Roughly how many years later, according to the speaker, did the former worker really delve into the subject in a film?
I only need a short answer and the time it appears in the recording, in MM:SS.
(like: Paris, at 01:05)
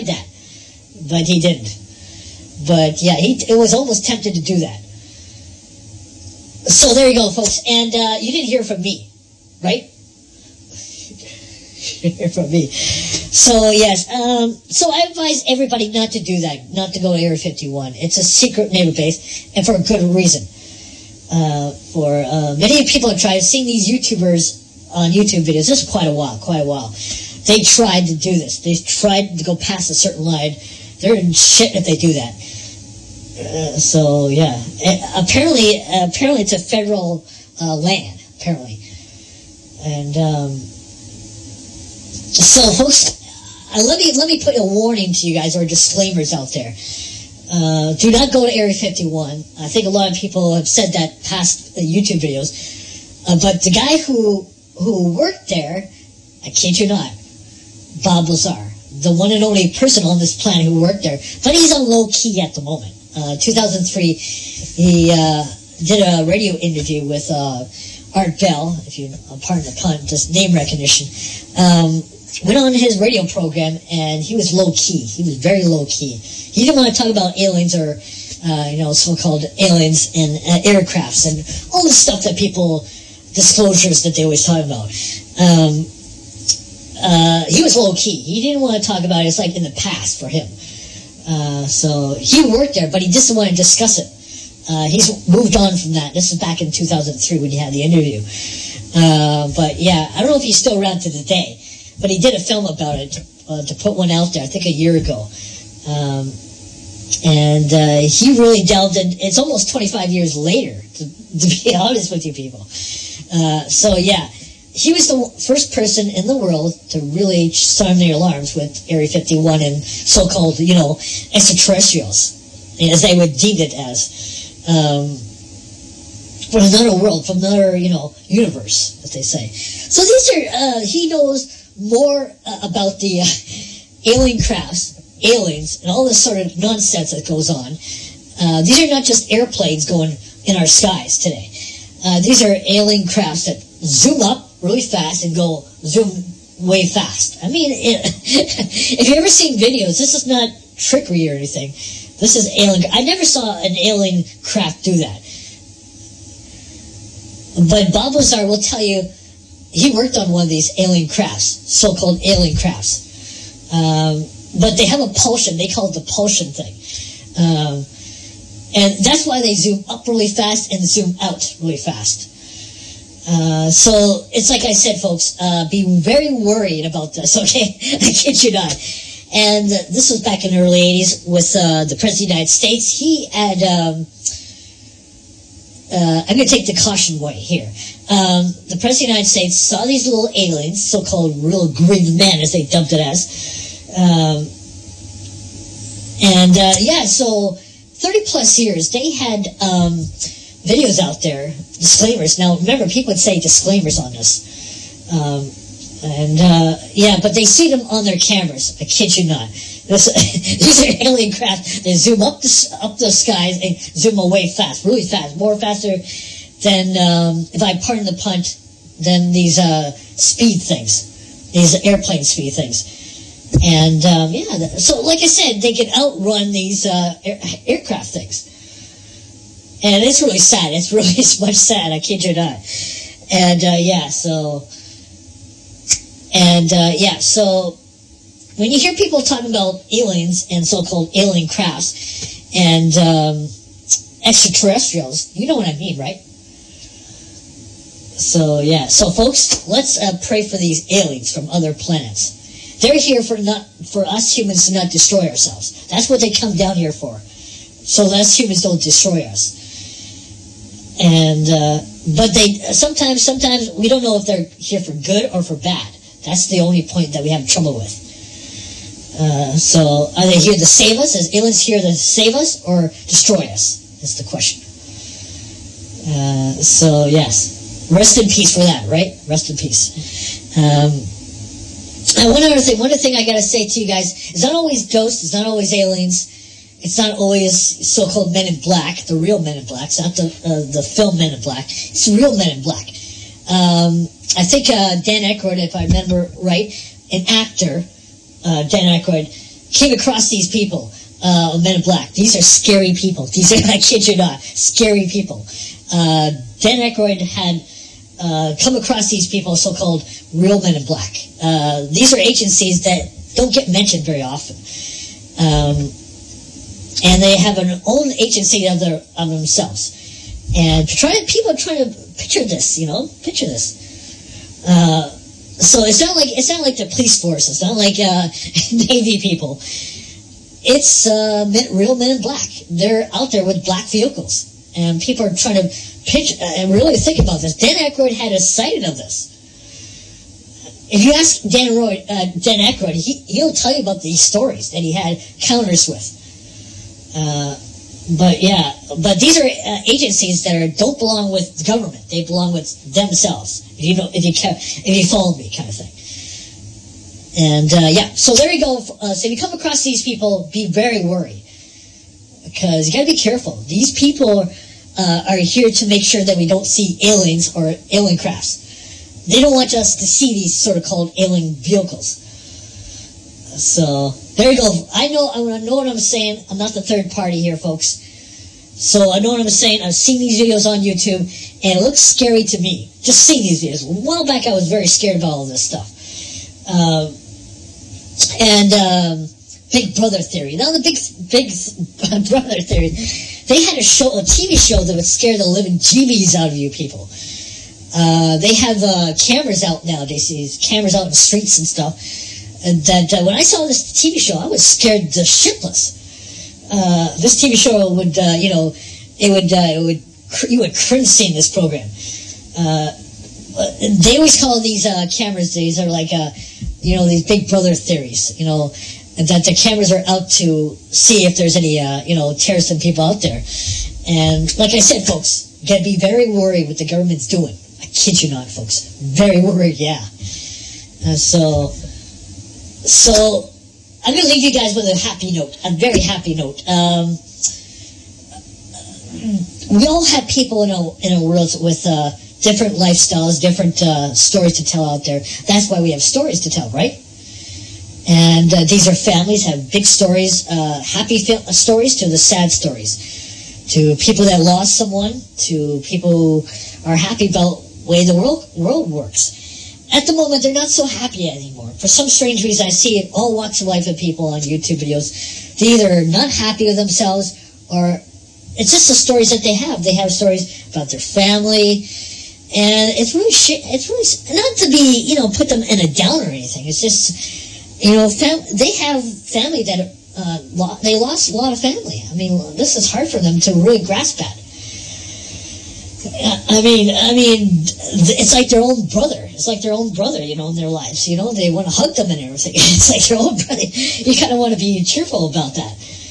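25, at 01:49.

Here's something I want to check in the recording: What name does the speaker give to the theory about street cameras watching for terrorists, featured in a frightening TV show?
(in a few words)
Big Brother theory.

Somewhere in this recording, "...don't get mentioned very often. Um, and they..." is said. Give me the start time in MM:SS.
05:13.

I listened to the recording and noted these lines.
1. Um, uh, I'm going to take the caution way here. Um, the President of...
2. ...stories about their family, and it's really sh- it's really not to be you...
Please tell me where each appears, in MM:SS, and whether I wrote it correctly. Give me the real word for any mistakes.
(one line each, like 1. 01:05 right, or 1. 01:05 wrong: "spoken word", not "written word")
1. 03:03 right
2. 07:50 right.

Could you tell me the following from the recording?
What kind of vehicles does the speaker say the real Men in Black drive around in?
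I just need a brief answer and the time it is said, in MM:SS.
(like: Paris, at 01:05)
black vehicles, at 05:33.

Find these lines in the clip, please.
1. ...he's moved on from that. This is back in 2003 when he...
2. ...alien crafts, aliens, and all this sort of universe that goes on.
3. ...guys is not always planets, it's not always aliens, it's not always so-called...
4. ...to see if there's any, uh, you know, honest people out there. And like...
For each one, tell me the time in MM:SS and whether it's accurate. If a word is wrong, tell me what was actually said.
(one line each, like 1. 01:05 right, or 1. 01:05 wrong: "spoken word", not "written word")
1. 01:34 right
2. 02:14 wrong: "nonsense", not "universe"
3. 04:43 wrong: "ghosts", not "planets"
4. 07:00 wrong: "terrorist", not "honest".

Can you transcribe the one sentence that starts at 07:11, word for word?
so, so I'm gonna leave you guys with a happy note, a very happy note.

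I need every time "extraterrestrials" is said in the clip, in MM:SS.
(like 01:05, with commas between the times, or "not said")
02:01, 04:04.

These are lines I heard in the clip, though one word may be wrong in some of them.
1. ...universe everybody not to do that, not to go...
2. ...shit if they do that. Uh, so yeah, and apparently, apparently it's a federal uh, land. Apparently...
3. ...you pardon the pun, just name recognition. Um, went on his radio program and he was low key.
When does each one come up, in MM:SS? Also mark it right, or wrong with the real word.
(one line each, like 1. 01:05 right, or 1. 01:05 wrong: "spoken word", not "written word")
1. 00:15 wrong: "advise", not "universe"
2. 00:31 right
3. 01:08 right.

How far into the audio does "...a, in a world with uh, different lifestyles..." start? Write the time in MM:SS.
07:20.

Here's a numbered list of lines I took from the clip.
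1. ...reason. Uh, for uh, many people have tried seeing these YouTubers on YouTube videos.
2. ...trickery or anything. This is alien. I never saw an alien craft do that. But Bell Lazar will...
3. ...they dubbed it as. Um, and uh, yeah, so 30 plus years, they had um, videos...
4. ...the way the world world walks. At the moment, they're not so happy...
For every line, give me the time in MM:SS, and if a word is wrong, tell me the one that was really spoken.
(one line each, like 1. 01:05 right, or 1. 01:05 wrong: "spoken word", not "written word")
1. 00:20 right
2. 02:30 wrong: "Bob", not "Bell"
3. 03:12 right
4. 07:37 wrong: "works", not "walks".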